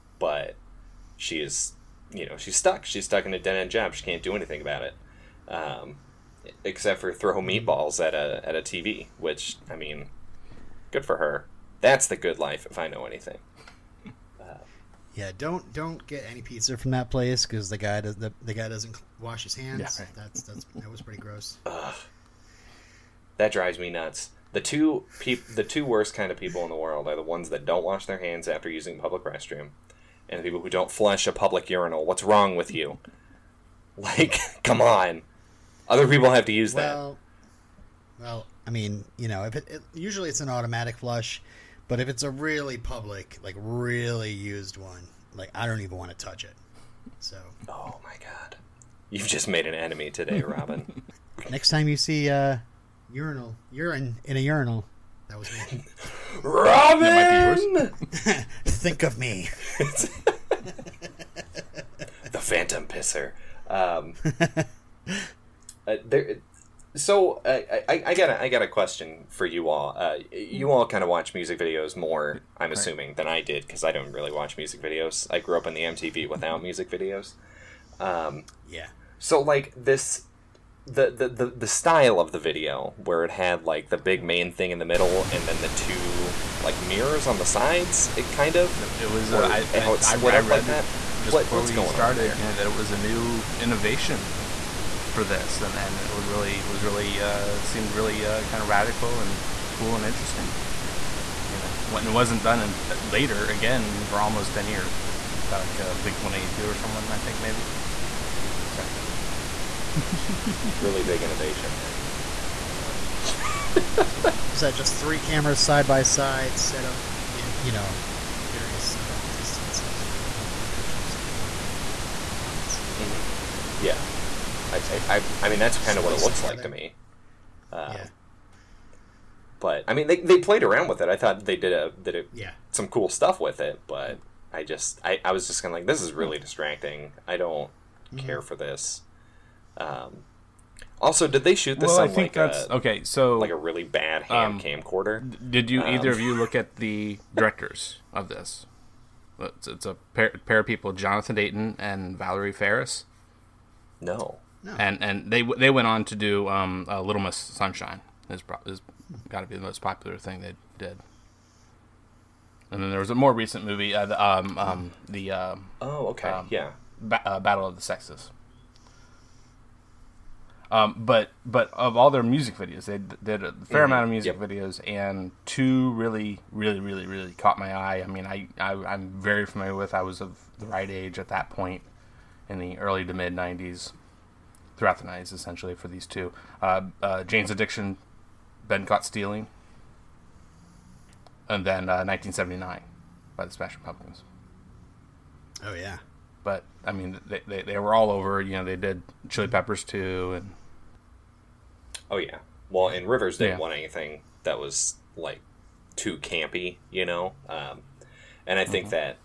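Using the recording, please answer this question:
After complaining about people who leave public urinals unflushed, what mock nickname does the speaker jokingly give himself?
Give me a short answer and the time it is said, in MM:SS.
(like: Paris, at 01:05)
The Phantom Pisser, at 01:02.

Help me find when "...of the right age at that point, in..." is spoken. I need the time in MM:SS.
03:00.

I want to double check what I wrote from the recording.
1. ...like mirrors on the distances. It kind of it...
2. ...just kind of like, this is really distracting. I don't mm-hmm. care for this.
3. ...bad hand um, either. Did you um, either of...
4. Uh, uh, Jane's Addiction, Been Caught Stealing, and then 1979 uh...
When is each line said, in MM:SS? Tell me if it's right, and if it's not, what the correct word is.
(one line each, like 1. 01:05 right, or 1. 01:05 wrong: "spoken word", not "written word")
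1. 01:26 wrong: "sides", not "distances"
2. 02:15 right
3. 02:23 wrong: "camcorder", not "either"
4. 03:06 right.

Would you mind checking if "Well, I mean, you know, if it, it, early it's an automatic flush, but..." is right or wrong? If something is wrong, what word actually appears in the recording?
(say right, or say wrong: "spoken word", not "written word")
wrong: "usually", not "early".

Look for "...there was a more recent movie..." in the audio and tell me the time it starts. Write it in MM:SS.
02:42.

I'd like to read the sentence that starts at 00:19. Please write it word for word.
Yeah, That's that's that was pretty gross.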